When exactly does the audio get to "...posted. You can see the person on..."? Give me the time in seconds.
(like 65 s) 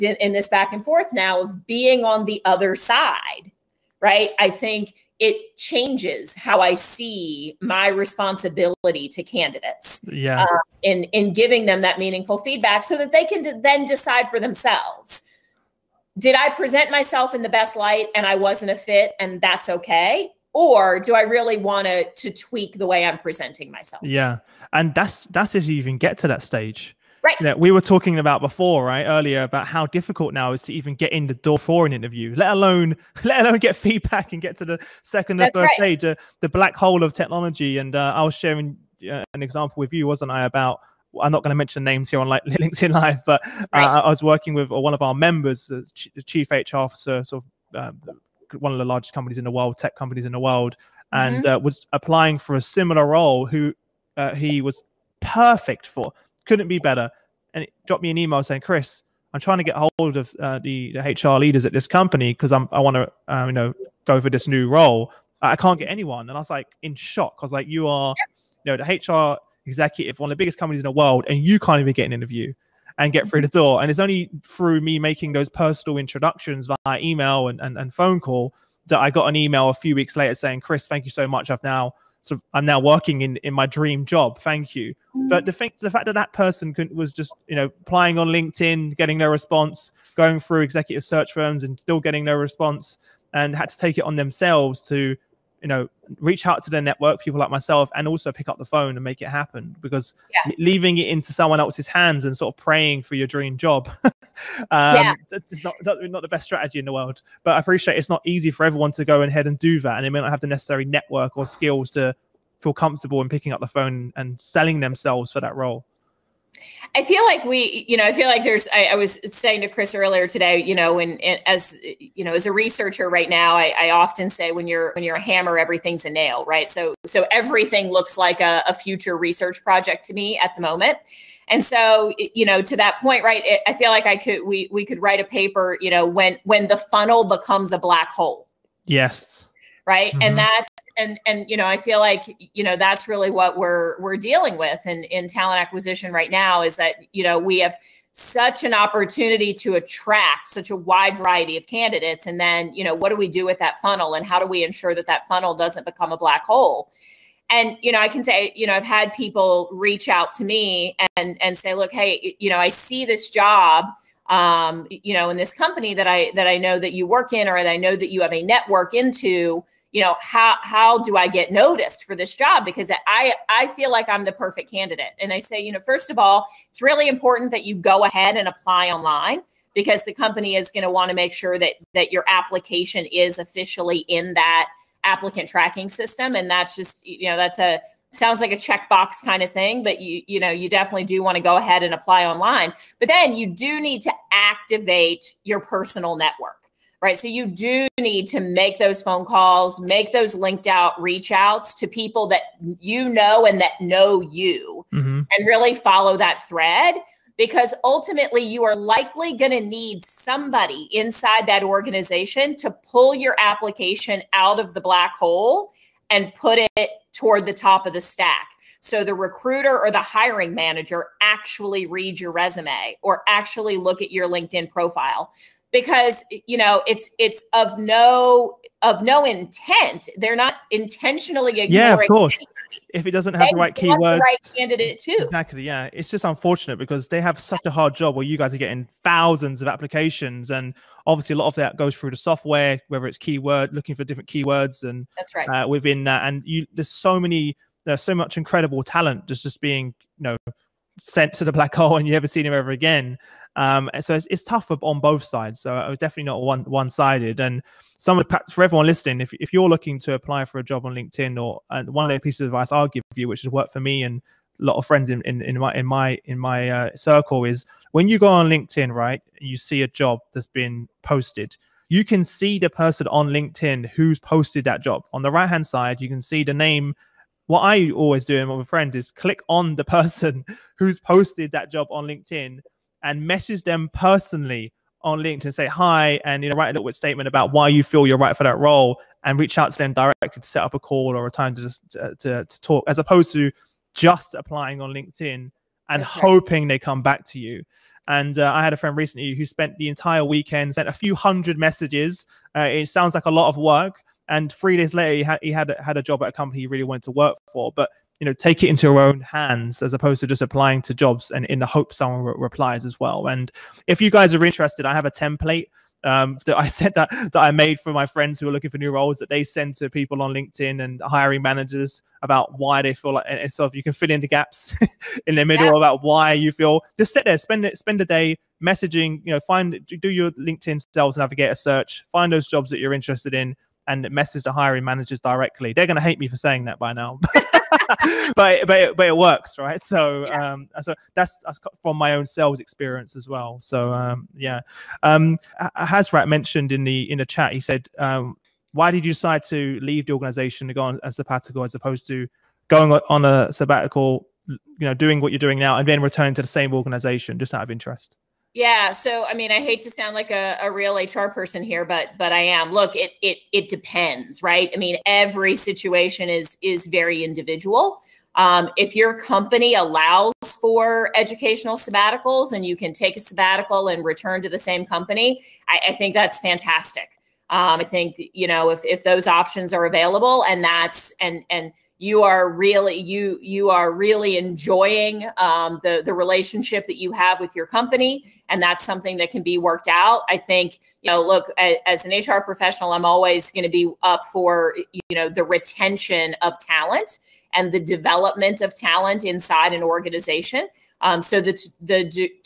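271 s.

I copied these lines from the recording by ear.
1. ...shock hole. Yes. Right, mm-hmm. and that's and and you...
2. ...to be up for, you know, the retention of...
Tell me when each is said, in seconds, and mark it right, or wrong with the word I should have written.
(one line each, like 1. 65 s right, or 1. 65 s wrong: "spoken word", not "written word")
1. 137 s wrong: "black", not "shock"
2. 393 s right.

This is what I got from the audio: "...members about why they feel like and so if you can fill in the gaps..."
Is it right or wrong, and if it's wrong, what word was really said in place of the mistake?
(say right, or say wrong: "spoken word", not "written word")
wrong: "managers", not "members".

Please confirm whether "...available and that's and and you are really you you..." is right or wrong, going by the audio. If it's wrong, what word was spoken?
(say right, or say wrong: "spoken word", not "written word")
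right.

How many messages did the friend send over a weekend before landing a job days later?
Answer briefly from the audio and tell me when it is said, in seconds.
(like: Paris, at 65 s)
a few hundred, at 300 s.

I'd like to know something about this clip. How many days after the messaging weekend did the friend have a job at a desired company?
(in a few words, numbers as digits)
3.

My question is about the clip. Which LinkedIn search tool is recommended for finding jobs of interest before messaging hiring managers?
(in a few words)
LinkedIn Sales Navigator.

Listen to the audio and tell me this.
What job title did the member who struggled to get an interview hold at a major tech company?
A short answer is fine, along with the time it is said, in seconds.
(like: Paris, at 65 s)
chief HR officer, at 46 s.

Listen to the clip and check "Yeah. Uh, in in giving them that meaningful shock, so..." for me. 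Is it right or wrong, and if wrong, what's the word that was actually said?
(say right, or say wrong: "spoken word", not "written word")
wrong: "feedback", not "shock".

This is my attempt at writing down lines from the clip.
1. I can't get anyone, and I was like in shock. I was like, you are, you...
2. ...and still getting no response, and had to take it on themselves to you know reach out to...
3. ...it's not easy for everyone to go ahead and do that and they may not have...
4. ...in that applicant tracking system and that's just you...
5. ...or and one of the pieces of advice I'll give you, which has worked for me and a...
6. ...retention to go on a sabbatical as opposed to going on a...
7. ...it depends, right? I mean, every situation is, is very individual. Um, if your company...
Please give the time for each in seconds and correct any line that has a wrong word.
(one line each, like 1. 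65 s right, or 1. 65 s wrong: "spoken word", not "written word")
1. 65 s right
2. 91 s right
3. 107 s right
4. 184 s right
5. 261 s right
6. 350 s wrong: "organization", not "retention"
7. 363 s right.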